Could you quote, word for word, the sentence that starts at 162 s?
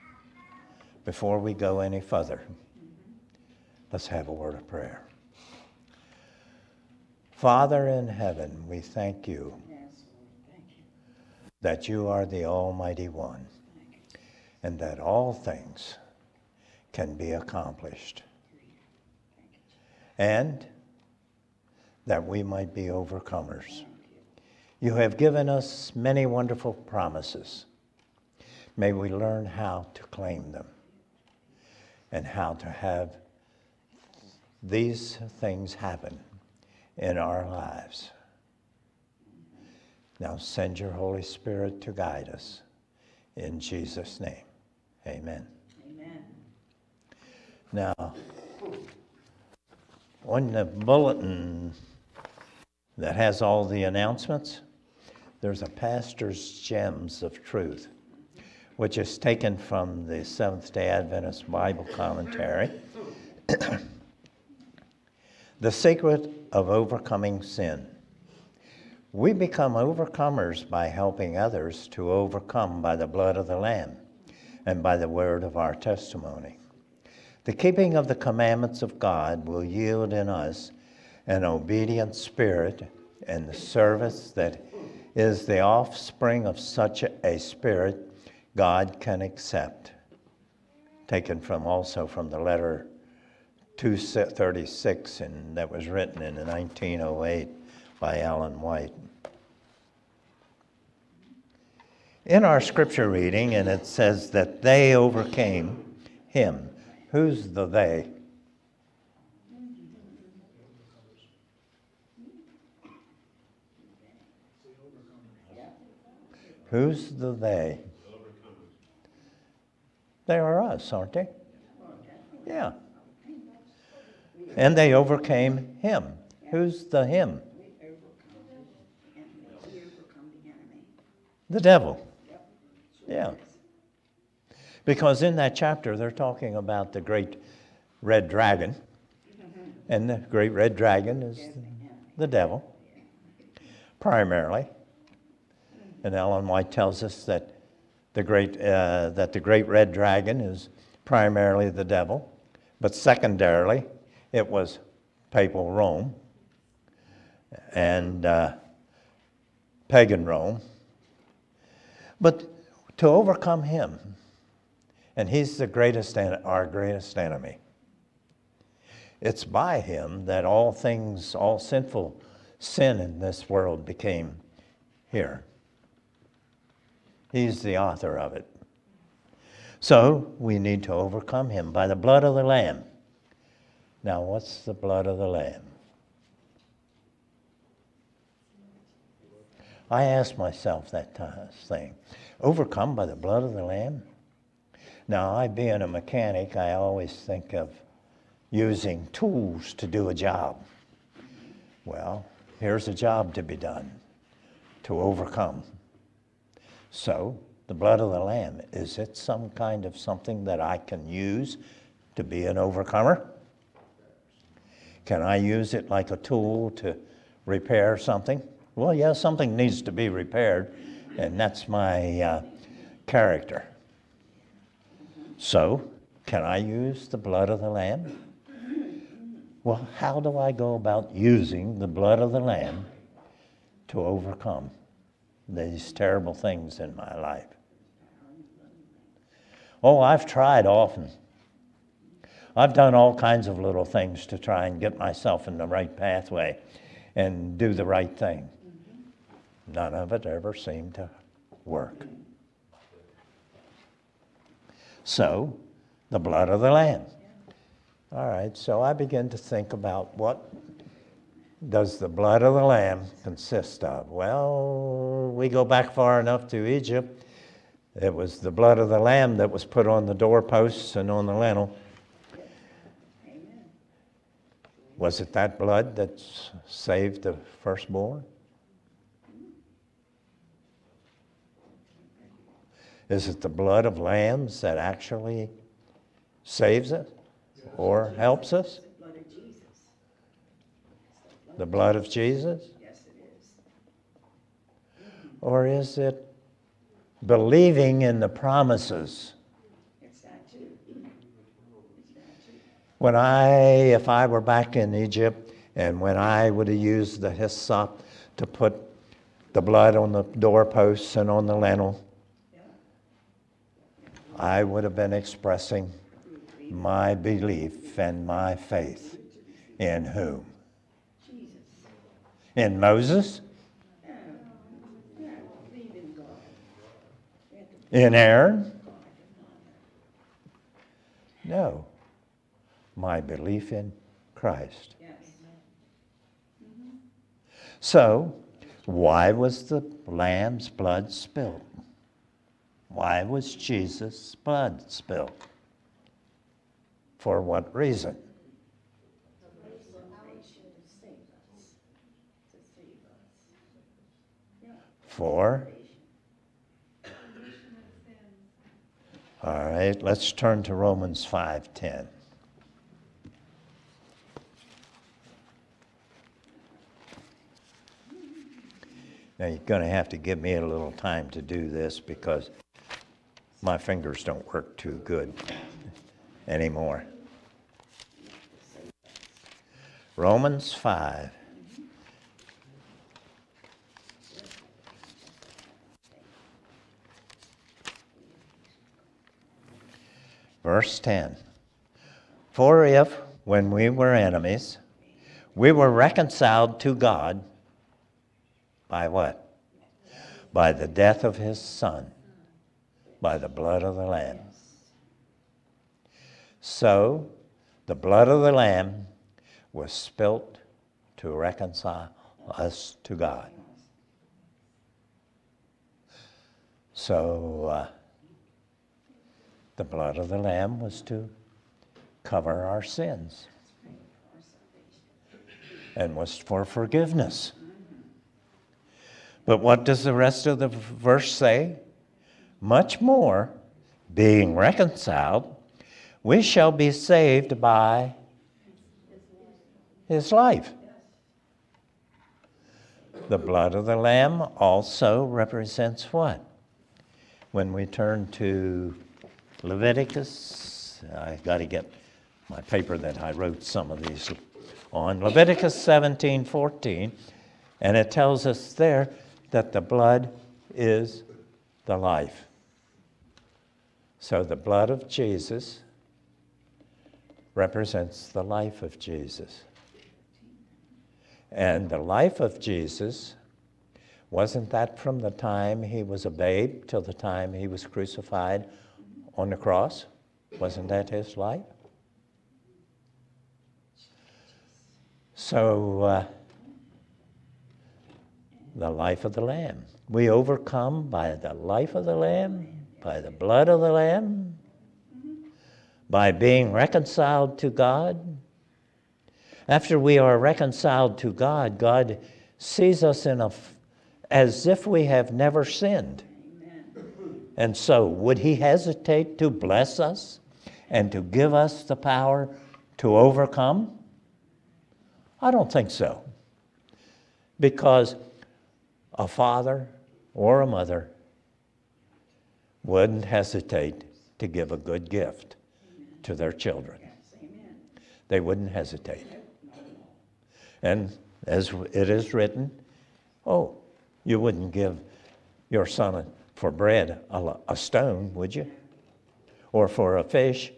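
But to overcome him, and he's the greatest, our greatest enemy.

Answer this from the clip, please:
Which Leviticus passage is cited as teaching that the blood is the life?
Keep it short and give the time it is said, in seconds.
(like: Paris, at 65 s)
Leviticus 17:14, at 455 s.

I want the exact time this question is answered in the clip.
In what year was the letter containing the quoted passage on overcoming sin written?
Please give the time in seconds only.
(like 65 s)
96 s.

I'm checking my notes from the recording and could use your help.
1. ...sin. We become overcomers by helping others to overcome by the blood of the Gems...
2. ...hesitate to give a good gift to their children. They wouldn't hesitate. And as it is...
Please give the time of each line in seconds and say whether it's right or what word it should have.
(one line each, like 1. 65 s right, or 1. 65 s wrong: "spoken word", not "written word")
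1. 67 s wrong: "Lamb", not "Gems"
2. 523 s right.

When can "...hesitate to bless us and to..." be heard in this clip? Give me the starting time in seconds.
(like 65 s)
508 s.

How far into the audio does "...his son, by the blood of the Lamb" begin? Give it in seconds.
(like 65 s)
401 s.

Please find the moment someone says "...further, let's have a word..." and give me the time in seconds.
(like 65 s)
2 s.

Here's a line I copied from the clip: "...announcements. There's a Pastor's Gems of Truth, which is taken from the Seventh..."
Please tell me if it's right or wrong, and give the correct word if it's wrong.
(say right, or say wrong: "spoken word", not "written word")
right.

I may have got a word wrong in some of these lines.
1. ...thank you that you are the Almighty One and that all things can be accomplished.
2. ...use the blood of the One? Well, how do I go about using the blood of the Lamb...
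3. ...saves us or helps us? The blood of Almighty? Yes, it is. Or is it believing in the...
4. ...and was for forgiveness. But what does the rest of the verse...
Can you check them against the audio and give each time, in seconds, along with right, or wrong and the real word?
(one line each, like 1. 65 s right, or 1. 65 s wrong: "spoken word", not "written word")
1. 8 s right
2. 226 s wrong: "Lamb", not "One"
3. 286 s wrong: "Jesus", not "Almighty"
4. 425 s right.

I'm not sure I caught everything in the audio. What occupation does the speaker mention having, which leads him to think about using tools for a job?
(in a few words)
Mechanic.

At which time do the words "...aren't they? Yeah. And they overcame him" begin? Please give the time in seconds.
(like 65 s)
120 s.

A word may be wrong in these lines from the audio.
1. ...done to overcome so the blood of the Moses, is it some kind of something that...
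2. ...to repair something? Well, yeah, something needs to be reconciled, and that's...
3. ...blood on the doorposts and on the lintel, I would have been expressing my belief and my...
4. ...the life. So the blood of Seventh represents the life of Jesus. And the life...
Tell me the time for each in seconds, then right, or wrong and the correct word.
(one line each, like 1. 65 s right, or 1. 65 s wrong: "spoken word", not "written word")
1. 203 s wrong: "Lamb", not "Moses"
2. 216 s wrong: "repaired", not "reconciled"
3. 309 s right
4. 461 s wrong: "Jesus", not "Seventh".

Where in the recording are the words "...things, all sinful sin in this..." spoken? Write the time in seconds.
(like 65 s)
170 s.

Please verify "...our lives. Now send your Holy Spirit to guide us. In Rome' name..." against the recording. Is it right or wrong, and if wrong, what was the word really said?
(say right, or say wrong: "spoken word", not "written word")
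wrong: "Jesus", not "Rome".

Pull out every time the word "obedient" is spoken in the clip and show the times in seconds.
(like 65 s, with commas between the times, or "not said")
81 s.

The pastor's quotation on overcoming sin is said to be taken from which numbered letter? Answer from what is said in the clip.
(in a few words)
Letter 236.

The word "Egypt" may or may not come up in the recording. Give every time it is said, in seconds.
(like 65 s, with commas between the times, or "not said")
266 s, 304 s.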